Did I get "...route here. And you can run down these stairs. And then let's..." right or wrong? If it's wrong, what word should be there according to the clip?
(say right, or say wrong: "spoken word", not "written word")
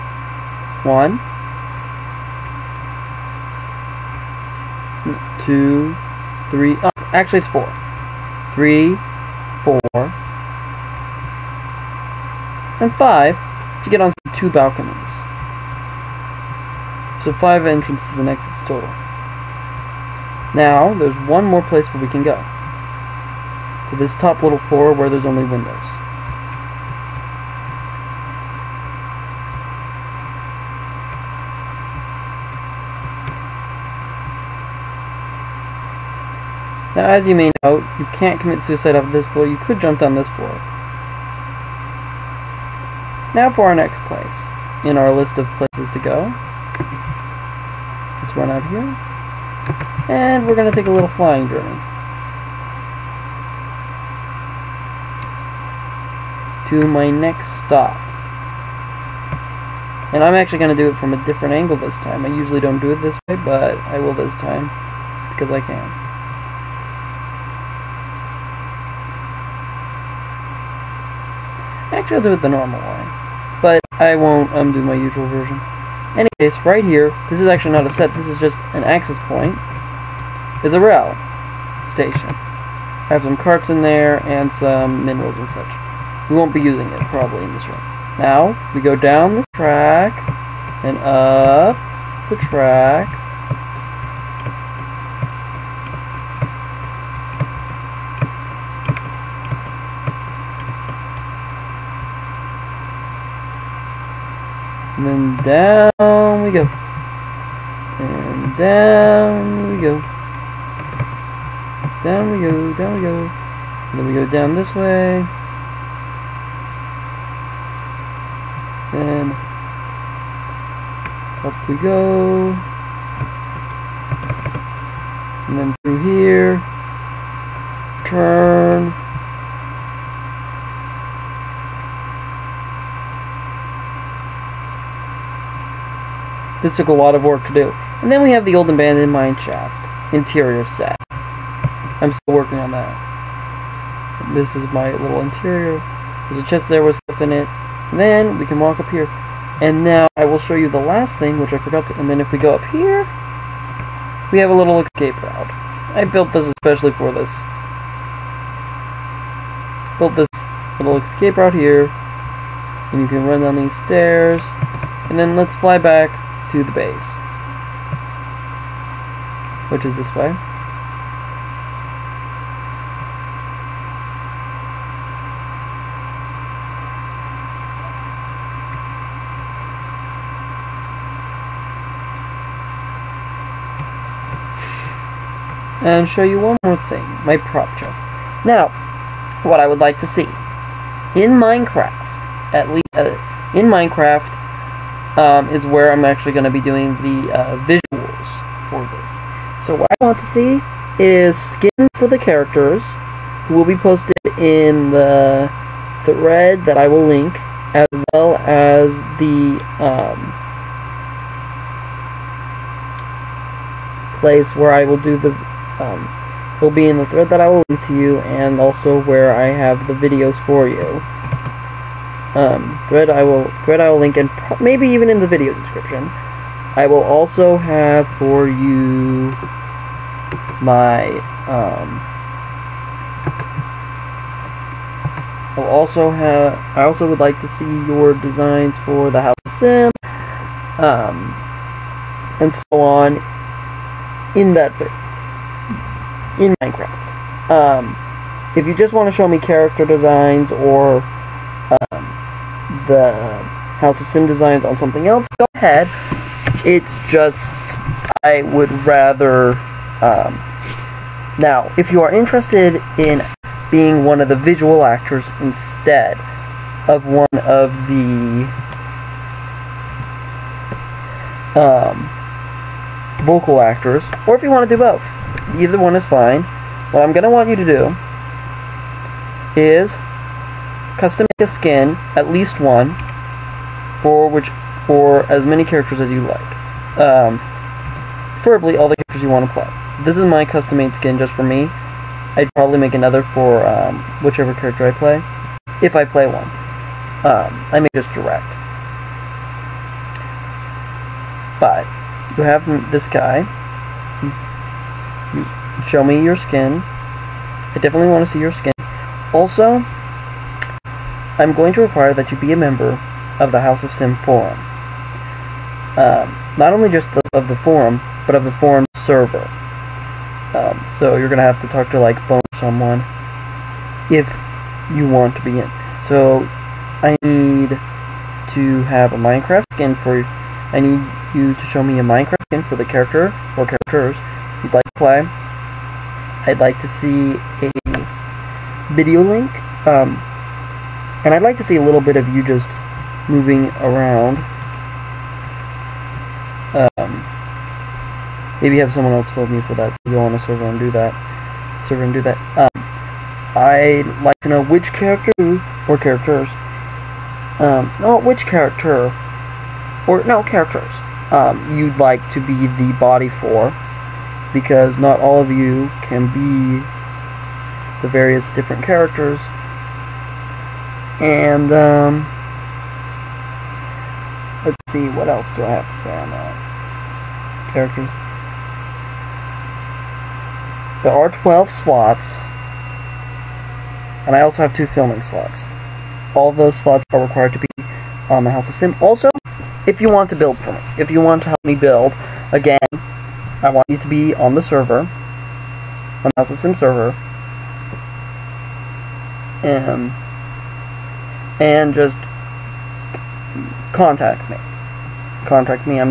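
right.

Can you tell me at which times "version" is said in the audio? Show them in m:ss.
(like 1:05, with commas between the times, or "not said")
1:15.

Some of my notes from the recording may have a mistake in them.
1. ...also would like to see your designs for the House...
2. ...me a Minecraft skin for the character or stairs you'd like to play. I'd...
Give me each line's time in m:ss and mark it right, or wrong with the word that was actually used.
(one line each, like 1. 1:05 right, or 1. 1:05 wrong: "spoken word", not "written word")
1. 3:56 right
2. 5:31 wrong: "characters", not "stairs".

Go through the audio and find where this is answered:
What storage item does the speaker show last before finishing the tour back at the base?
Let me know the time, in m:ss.
3:07.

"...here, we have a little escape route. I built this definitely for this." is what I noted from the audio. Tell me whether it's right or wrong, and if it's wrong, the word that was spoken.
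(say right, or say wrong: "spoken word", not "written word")
wrong: "especially", not "definitely".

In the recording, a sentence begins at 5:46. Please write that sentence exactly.
Um, maybe have someone else fill me for that.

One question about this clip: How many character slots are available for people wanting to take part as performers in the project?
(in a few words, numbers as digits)
12.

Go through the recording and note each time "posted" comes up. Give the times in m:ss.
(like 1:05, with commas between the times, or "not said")
3:23.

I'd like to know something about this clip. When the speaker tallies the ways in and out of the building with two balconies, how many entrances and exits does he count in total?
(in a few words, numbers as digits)
5.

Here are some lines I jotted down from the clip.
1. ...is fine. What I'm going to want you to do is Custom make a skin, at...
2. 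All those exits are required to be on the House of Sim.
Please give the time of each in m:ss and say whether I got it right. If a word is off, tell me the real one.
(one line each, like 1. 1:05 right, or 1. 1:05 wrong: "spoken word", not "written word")
1. 4:35 right
2. 6:26 wrong: "slots", not "exits".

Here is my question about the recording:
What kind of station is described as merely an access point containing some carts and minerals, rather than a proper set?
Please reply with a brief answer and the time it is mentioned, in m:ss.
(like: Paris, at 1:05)
rail station, at 1:20.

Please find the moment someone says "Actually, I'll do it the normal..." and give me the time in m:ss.
1:11.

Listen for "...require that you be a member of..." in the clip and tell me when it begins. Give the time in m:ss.
5:11.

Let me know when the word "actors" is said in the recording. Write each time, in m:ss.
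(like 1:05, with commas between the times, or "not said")
4:24, 4:33.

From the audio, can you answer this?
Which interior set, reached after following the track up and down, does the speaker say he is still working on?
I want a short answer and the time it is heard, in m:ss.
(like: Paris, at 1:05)
old abandoned mine shaft, at 2:18.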